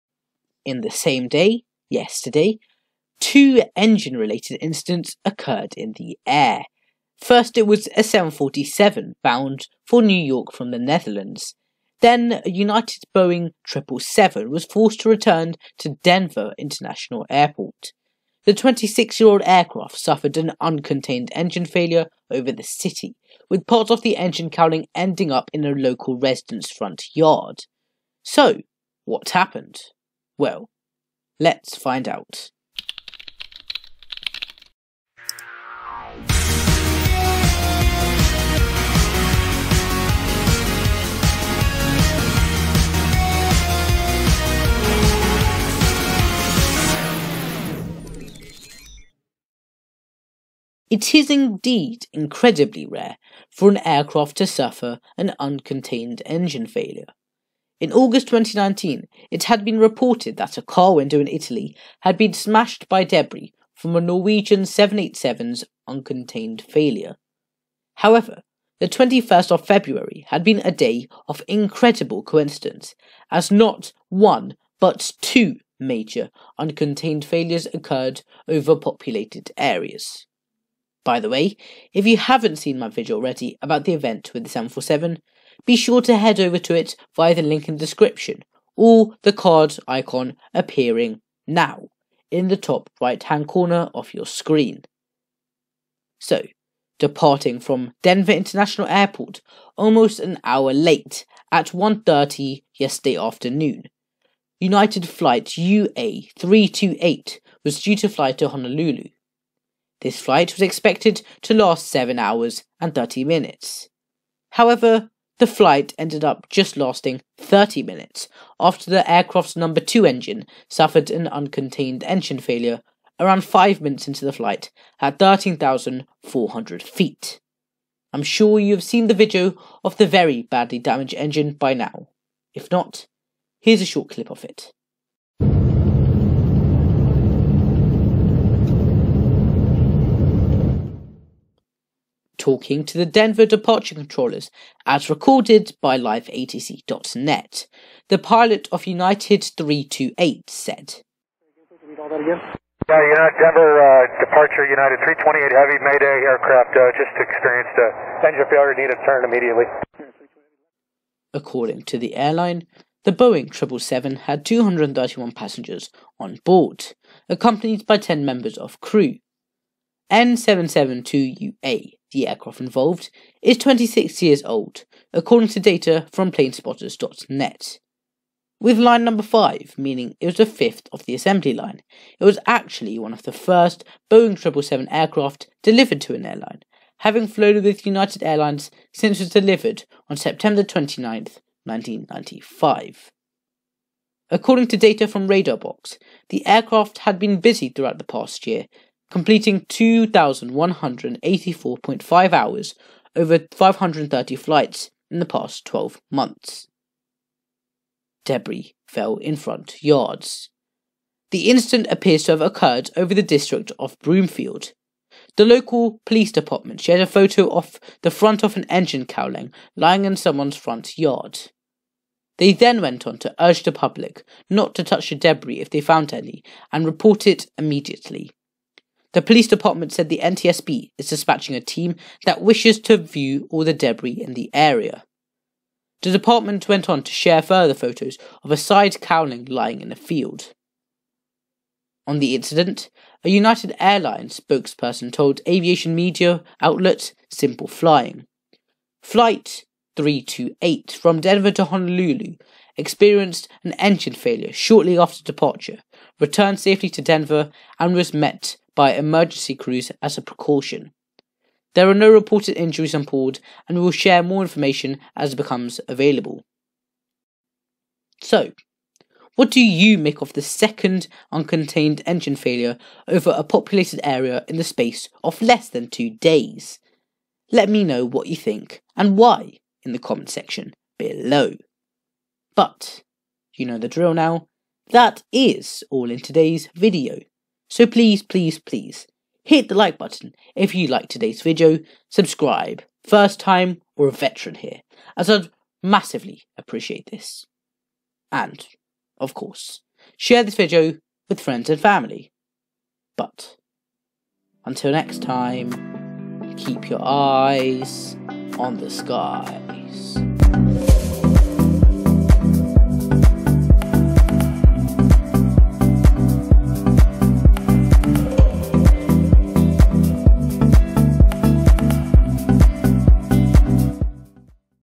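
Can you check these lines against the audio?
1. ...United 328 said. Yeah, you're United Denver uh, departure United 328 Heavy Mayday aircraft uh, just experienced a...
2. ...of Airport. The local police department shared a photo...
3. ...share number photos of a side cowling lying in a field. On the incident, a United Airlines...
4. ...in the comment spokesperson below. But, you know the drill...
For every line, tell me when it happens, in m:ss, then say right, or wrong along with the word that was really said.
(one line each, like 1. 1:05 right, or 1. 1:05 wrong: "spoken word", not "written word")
1. 2:28 right
2. 3:33 wrong: "Broomfield", not "Airport"
3. 3:57 wrong: "further", not "number"
4. 4:39 wrong: "section", not "spokesperson".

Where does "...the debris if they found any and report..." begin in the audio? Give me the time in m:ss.
3:45.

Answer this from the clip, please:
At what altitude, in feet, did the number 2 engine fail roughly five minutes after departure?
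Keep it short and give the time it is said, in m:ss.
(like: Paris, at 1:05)
13,400 feet, at 2:05.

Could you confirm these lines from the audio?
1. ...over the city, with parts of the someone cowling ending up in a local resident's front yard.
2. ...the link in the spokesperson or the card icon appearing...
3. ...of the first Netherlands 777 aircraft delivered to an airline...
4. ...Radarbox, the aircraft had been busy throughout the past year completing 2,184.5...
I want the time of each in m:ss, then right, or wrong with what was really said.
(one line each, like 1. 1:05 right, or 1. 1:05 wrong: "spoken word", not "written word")
1. 0:22 wrong: "engine", not "someone"
2. 1:27 wrong: "description", not "spokesperson"
3. 3:03 wrong: "Boeing", not "Netherlands"
4. 3:15 right.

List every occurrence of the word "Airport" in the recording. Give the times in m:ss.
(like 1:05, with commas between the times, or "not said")
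0:17, 1:38.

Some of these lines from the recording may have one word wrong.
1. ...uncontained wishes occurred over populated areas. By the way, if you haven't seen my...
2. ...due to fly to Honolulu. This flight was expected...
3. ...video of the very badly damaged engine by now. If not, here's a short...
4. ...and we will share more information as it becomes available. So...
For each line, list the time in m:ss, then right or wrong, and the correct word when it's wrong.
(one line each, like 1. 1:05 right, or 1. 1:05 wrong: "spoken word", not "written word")
1. 1:16 wrong: "failures", not "wishes"
2. 1:47 right
3. 2:09 right
4. 4:23 right.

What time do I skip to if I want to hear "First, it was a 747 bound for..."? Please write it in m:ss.
0:07.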